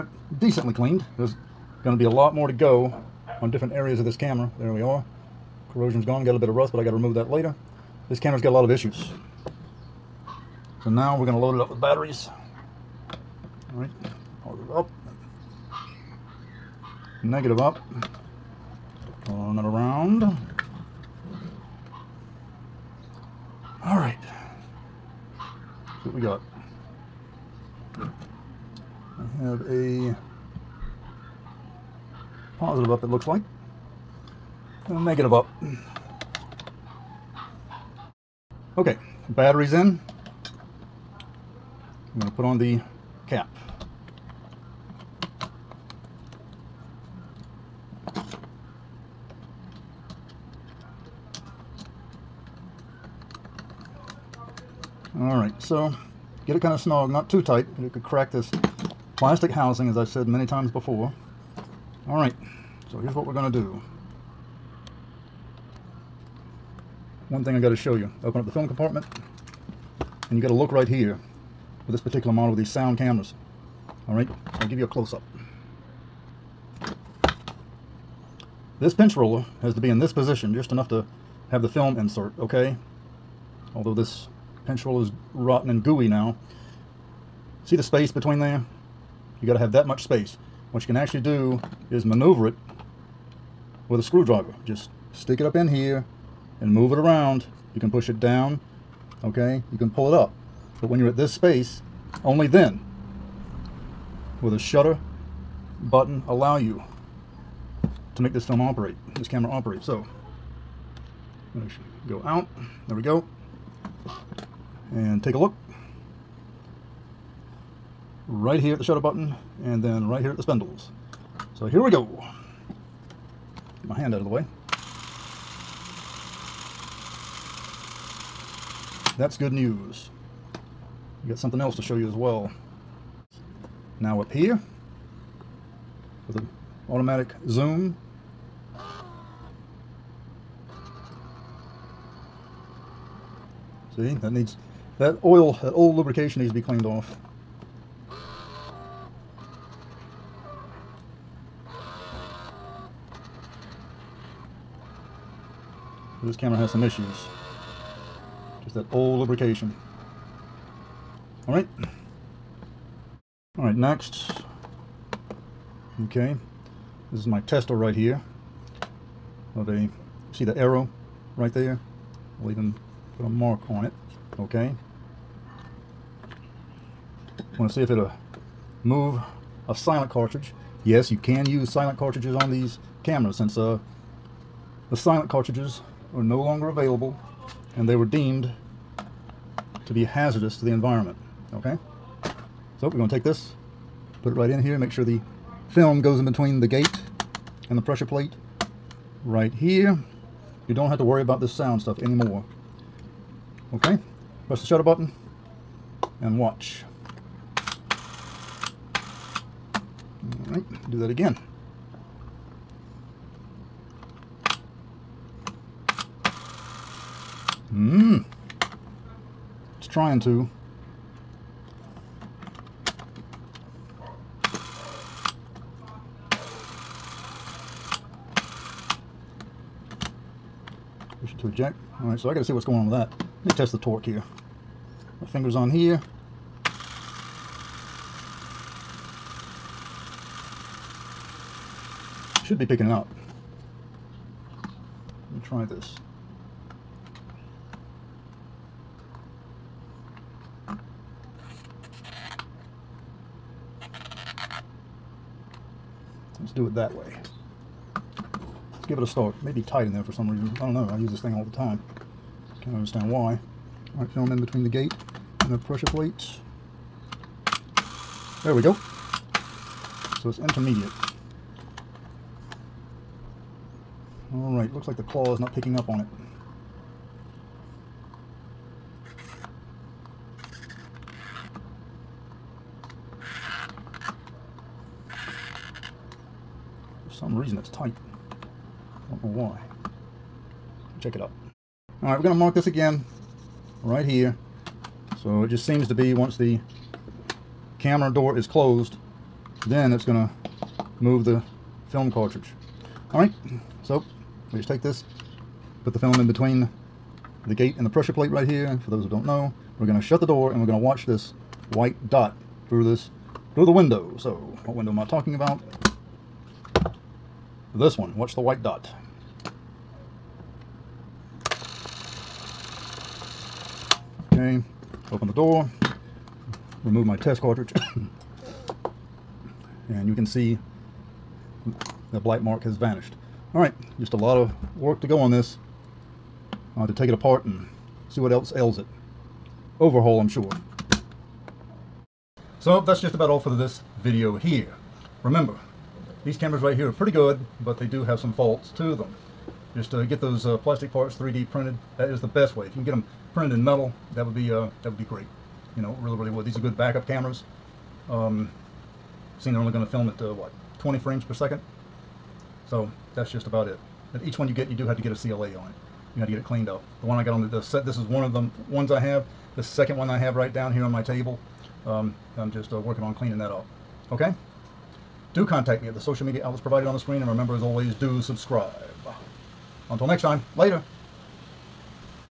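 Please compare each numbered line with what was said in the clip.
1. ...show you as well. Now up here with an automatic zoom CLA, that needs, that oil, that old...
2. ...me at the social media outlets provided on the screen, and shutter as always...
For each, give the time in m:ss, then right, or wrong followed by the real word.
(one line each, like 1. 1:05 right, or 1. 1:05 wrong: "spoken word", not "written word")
1. 2:11 wrong: "See", not "CLA"
2. 6:15 wrong: "remember", not "shutter".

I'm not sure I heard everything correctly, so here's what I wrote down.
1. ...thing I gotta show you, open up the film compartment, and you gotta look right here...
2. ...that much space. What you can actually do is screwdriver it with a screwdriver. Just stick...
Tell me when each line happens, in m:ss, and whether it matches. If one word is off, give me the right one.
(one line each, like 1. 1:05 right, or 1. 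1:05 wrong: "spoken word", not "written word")
1. 1:07 right
2. 1:29 wrong: "maneuver", not "screwdriver".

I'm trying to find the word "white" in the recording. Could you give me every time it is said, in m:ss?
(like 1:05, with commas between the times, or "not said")
5:11, 5:18.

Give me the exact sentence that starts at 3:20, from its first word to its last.
You don't have to worry about this sound stuff anymore.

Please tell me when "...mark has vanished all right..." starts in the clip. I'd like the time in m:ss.
5:32.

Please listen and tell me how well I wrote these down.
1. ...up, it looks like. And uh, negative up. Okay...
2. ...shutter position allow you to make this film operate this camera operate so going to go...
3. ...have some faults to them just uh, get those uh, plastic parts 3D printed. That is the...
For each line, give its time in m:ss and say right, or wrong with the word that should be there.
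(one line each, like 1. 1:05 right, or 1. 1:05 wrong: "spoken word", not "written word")
1. 0:32 right
2. 1:44 wrong: "button", not "position"
3. 5:48 right.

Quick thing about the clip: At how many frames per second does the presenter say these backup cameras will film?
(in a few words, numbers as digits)
20.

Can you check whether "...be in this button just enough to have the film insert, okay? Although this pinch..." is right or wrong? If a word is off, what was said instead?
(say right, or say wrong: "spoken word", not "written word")
wrong: "position", not "button".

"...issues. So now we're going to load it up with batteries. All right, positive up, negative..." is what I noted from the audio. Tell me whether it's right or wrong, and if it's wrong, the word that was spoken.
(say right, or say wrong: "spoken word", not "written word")
right.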